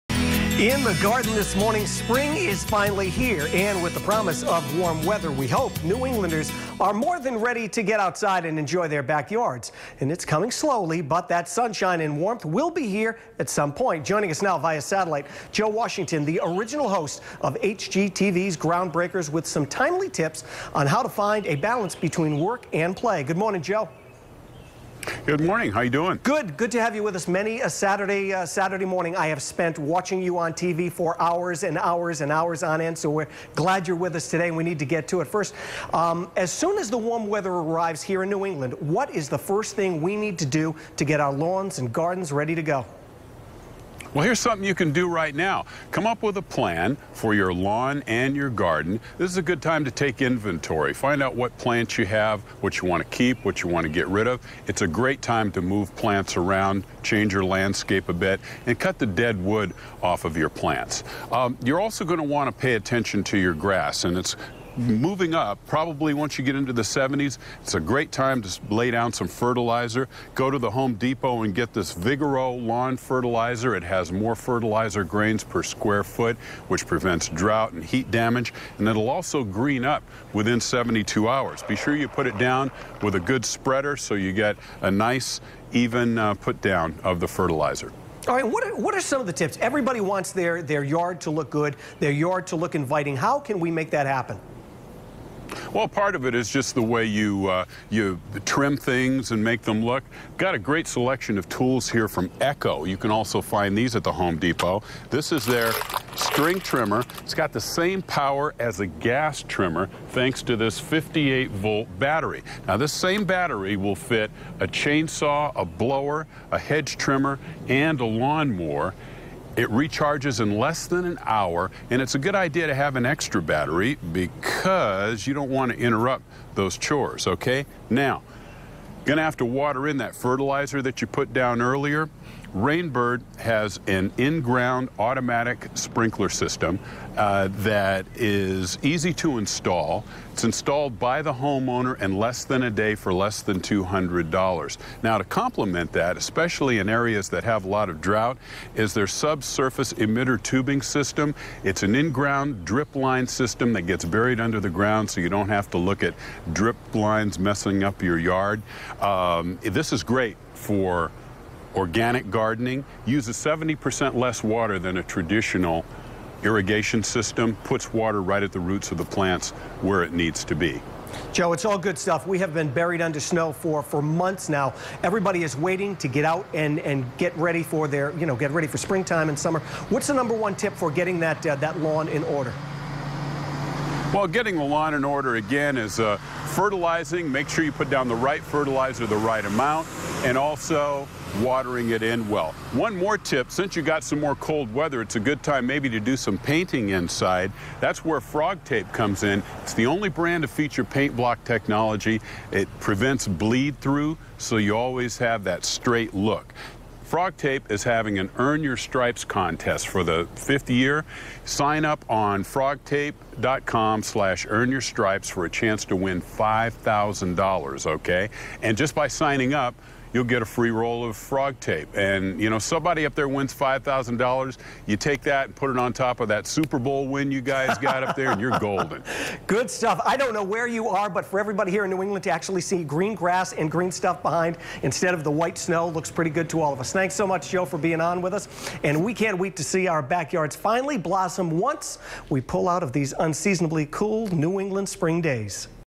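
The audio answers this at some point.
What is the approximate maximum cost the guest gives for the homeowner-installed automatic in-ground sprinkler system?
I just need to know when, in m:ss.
2:23.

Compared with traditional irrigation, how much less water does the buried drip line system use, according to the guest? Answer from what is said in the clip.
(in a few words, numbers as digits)
70%.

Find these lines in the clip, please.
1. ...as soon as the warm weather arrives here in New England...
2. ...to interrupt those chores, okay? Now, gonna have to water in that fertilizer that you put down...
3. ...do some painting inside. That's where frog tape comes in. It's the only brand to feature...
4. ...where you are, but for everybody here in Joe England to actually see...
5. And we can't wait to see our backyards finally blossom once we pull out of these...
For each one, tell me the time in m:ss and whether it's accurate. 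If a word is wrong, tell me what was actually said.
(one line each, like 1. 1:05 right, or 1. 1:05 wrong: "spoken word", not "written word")
1. 0:36 right
2. 2:05 right
3. 3:15 right
4. 3:50 wrong: "New", not "Joe"
5. 3:58 right.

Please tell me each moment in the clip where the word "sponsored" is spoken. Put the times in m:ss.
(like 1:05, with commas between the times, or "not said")
not said.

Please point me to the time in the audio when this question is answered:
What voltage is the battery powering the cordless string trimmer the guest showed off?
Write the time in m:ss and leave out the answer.
1:50.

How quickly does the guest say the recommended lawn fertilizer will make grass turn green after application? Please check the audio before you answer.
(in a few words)
72 hours.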